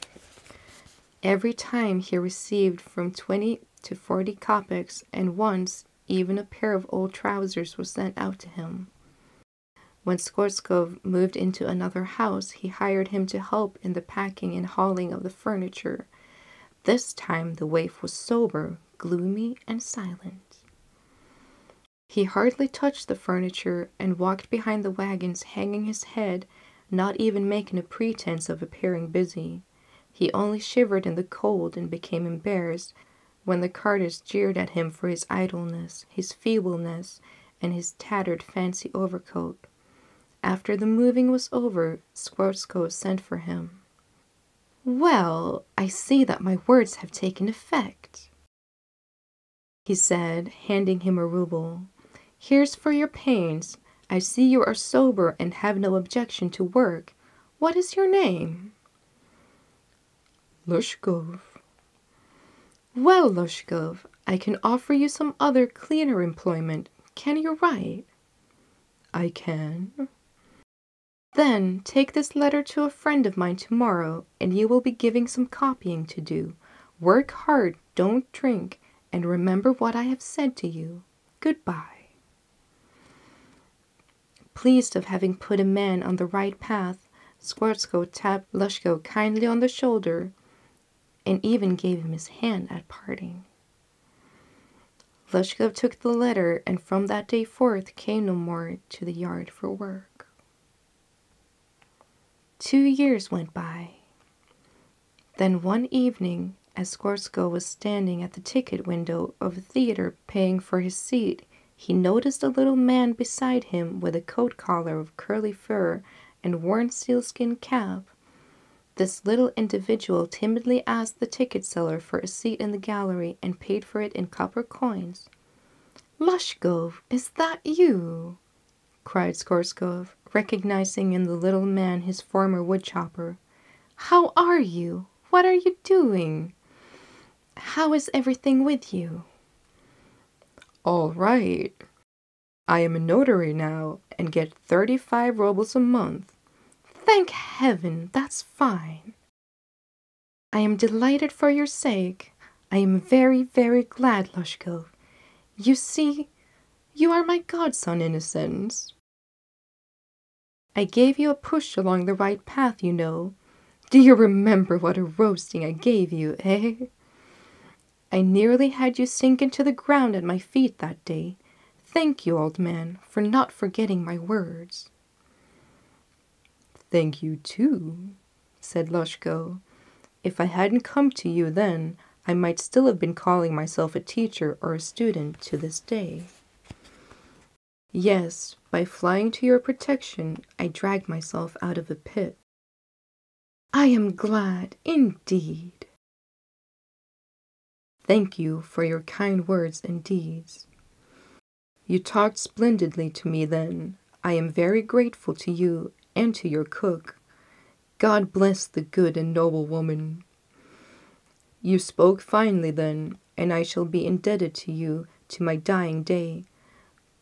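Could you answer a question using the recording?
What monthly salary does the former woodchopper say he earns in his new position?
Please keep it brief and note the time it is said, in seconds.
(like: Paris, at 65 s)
35 roubles, at 144 s.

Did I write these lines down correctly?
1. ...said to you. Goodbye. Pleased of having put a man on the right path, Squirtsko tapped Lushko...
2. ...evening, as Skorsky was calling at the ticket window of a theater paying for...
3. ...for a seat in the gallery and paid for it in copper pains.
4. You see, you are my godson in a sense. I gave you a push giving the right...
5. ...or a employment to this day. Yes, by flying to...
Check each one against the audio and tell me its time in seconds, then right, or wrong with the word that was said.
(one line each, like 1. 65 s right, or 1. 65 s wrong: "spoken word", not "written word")
1. 80 s right
2. 105 s wrong: "standing", not "calling"
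3. 121 s wrong: "coins", not "pains"
4. 155 s wrong: "along", not "giving"
5. 184 s wrong: "student", not "employment".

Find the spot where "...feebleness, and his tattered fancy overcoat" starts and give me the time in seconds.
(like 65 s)
36 s.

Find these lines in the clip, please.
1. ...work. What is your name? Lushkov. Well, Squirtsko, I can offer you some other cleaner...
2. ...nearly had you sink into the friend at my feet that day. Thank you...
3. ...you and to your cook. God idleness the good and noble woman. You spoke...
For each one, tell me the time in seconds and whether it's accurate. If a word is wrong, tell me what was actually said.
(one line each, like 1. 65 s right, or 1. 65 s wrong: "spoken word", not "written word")
1. 56 s wrong: "Lushkov", not "Squirtsko"
2. 168 s wrong: "ground", not "friend"
3. 205 s wrong: "bless", not "idleness".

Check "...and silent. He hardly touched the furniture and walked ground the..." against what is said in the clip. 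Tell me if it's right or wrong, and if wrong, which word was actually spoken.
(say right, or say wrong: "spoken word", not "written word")
wrong: "behind", not "ground".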